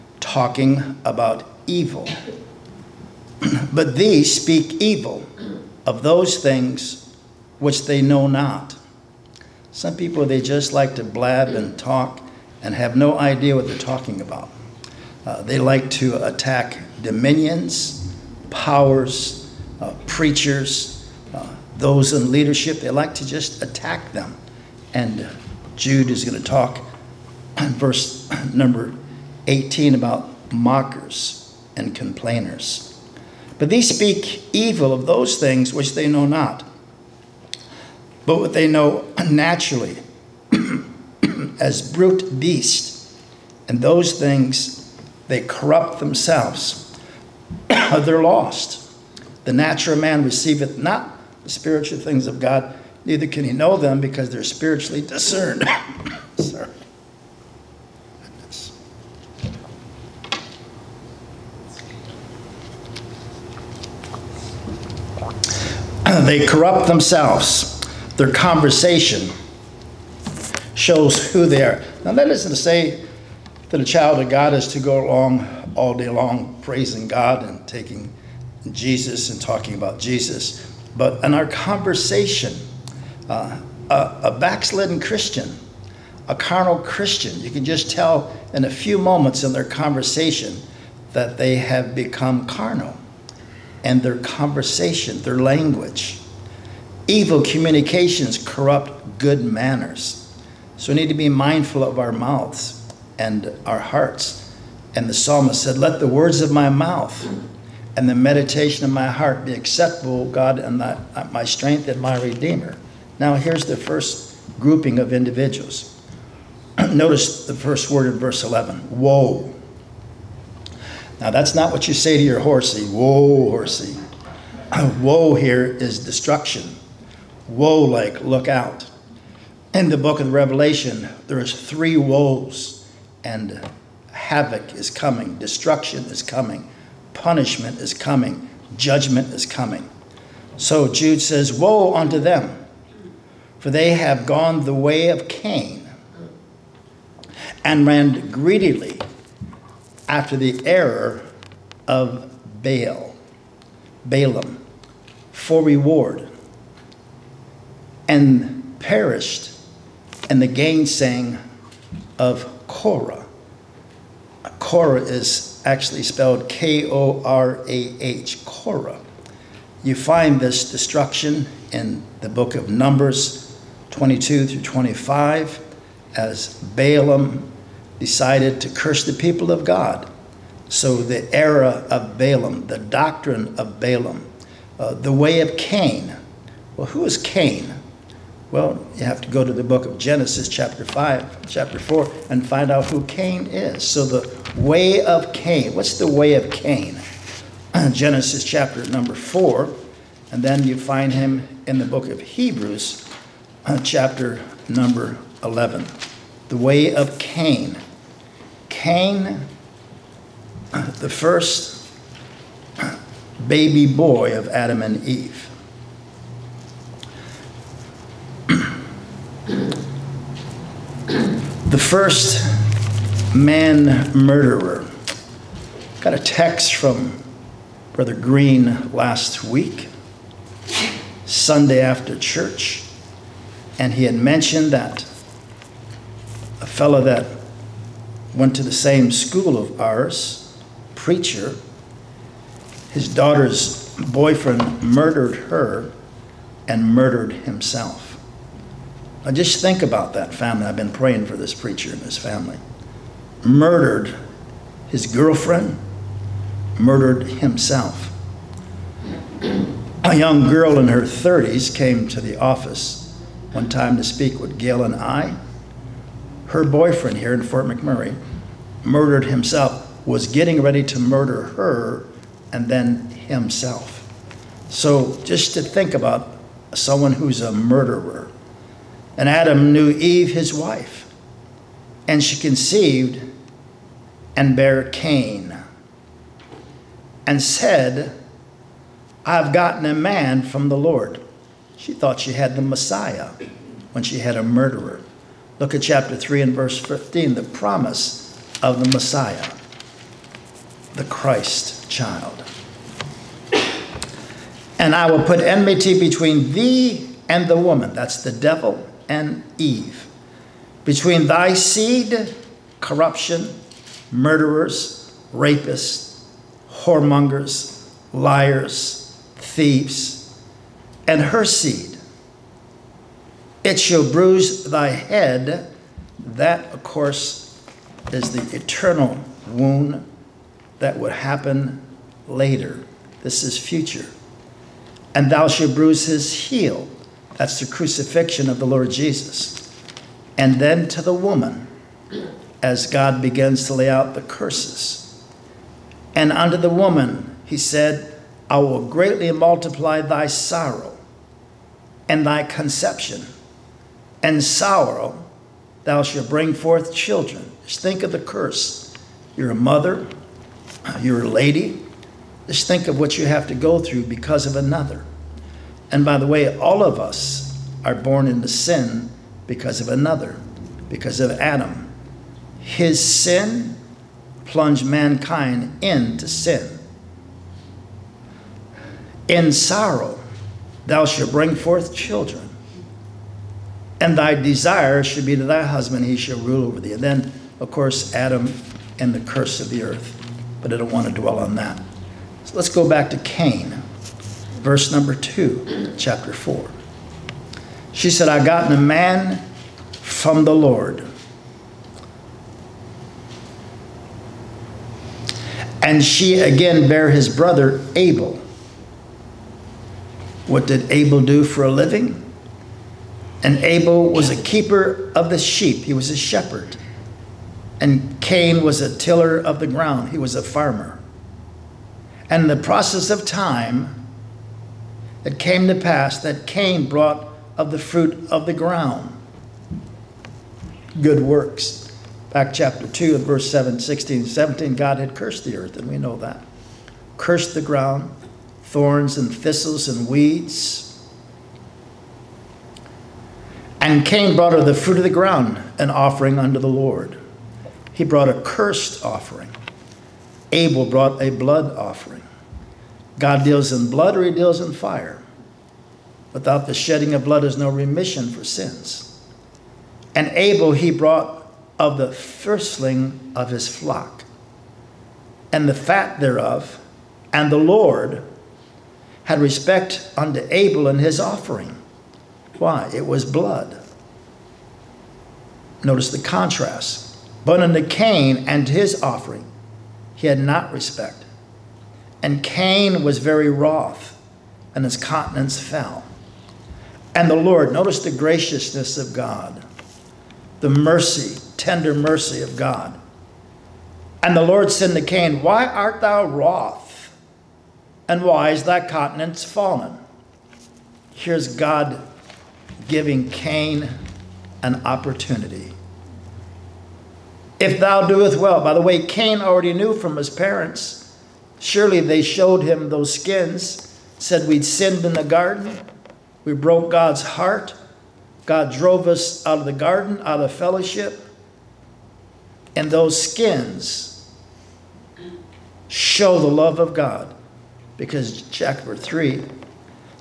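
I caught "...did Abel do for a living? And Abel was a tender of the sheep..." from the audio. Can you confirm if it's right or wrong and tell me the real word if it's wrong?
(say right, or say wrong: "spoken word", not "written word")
wrong: "keeper", not "tender".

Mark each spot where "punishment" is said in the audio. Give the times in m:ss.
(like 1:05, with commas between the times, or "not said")
2:17.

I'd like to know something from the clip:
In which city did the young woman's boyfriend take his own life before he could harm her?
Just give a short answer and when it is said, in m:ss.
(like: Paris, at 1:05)
Fort McMurray, at 4:27.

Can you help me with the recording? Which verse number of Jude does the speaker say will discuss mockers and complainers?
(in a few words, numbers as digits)
18.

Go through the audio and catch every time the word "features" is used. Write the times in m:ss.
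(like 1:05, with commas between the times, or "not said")
not said.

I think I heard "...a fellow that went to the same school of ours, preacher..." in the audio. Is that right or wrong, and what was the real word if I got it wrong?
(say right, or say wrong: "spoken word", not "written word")
right.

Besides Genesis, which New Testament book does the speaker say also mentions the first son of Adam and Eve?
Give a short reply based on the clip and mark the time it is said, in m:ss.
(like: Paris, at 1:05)
Hebrews, at 3:22.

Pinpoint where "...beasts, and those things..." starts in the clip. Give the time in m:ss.
0:42.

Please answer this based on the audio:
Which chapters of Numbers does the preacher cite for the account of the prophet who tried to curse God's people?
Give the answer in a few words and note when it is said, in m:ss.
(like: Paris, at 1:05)
22 through 25, at 2:52.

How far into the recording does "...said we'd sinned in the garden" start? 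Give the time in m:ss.
8:34.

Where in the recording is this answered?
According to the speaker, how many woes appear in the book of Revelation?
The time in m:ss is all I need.
2:11.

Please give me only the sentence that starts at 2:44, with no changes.
Korah is actually spelled K O R A H, Korah.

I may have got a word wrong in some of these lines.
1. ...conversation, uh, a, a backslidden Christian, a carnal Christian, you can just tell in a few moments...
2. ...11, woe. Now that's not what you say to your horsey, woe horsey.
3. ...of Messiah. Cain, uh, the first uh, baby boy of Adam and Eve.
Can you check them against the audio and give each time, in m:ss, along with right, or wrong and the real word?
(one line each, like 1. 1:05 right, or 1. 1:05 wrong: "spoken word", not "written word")
1. 1:21 right
2. 1:58 right
3. 3:26 wrong: "Cain", not "Messiah".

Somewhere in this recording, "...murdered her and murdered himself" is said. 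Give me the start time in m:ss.
4:04.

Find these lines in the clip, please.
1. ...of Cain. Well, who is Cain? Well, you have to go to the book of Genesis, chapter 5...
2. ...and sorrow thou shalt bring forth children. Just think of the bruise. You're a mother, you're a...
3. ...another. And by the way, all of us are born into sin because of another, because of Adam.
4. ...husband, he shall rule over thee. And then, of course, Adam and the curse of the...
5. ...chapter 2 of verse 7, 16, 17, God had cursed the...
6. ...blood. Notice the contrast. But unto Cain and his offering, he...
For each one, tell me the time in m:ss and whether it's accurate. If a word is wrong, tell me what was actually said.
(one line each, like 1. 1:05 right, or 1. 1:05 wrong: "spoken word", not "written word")
1. 3:05 right
2. 5:54 wrong: "curse", not "bruise"
3. 6:04 right
4. 6:25 right
5. 7:12 right
6. 7:53 right.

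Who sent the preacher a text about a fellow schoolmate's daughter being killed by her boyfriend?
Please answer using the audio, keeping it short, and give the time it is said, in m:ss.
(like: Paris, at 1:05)
Brother Green, at 3:47.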